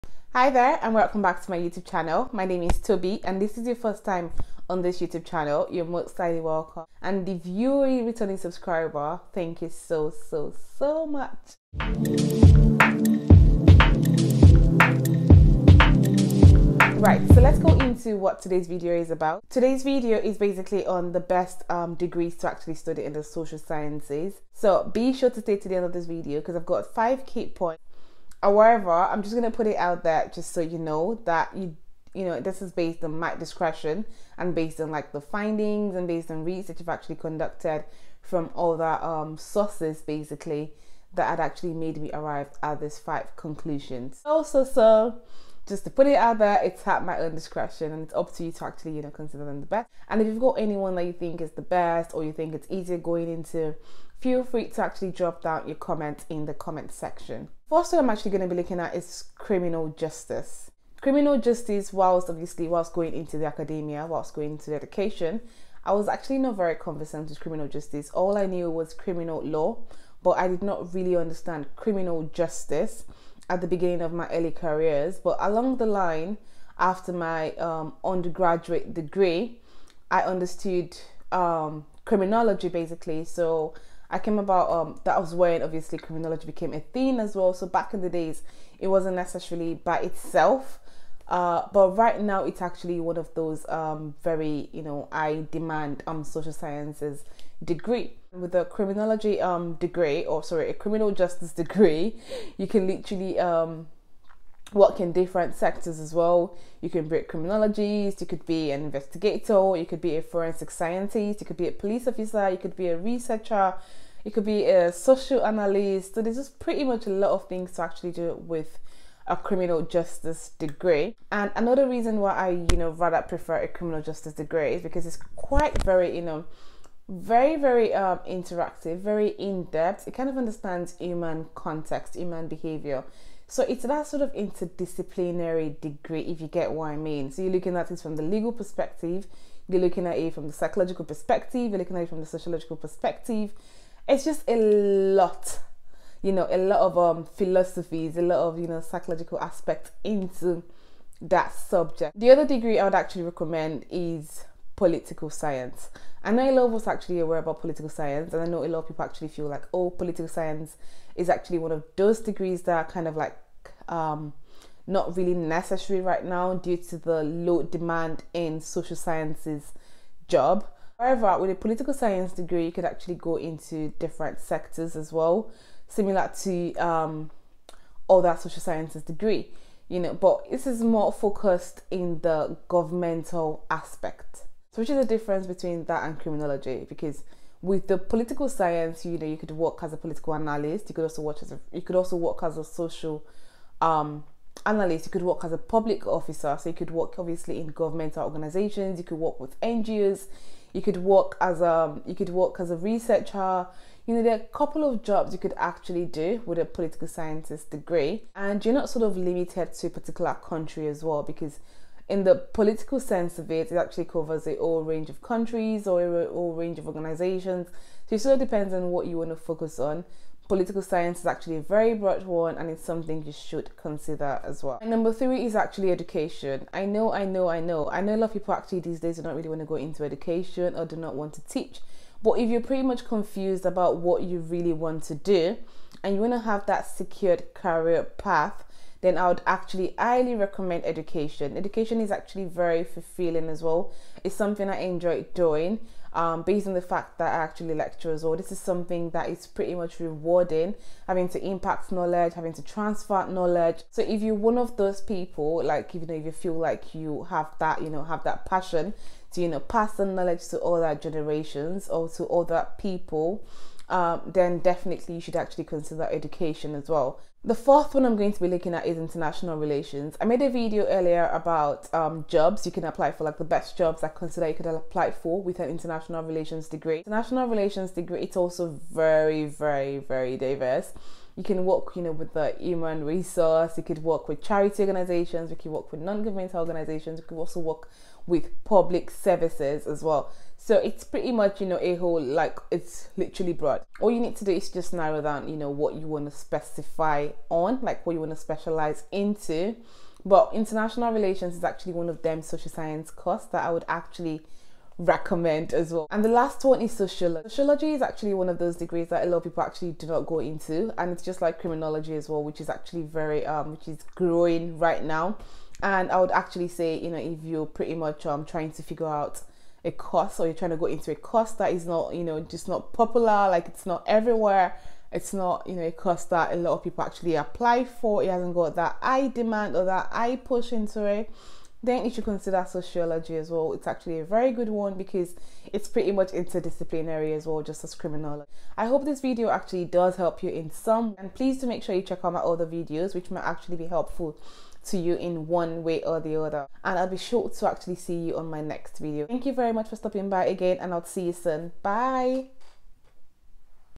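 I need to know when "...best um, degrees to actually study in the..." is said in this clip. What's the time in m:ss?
0:21.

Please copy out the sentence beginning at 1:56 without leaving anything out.
So there's just pretty much a lot of things to actually do with a criminal justice degree.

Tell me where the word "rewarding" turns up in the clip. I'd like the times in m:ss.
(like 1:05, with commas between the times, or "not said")
4:09.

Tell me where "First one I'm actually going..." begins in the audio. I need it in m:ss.
0:57.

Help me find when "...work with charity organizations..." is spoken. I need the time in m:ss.
4:43.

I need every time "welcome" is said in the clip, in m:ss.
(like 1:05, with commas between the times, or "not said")
0:00, 0:06.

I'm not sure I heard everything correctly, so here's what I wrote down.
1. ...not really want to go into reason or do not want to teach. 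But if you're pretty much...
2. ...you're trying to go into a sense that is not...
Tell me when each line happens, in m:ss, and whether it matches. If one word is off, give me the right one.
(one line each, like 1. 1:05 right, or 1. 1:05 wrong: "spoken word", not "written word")
1. 3:49 wrong: "education", not "reason"
2. 5:20 wrong: "course", not "sense".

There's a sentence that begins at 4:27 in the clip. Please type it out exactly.
The fourth one I'm going to be looking at is international relations.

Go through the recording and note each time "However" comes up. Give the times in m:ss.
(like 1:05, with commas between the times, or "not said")
0:28, 2:50.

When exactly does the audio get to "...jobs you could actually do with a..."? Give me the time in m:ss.
3:25.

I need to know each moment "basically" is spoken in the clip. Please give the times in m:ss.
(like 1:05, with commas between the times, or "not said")
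0:20, 0:40, 1:22.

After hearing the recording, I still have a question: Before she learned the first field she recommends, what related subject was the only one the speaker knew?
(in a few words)
Criminal law.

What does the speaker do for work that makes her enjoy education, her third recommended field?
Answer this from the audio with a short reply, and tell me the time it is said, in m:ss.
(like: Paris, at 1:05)
Lecture, at 4:07.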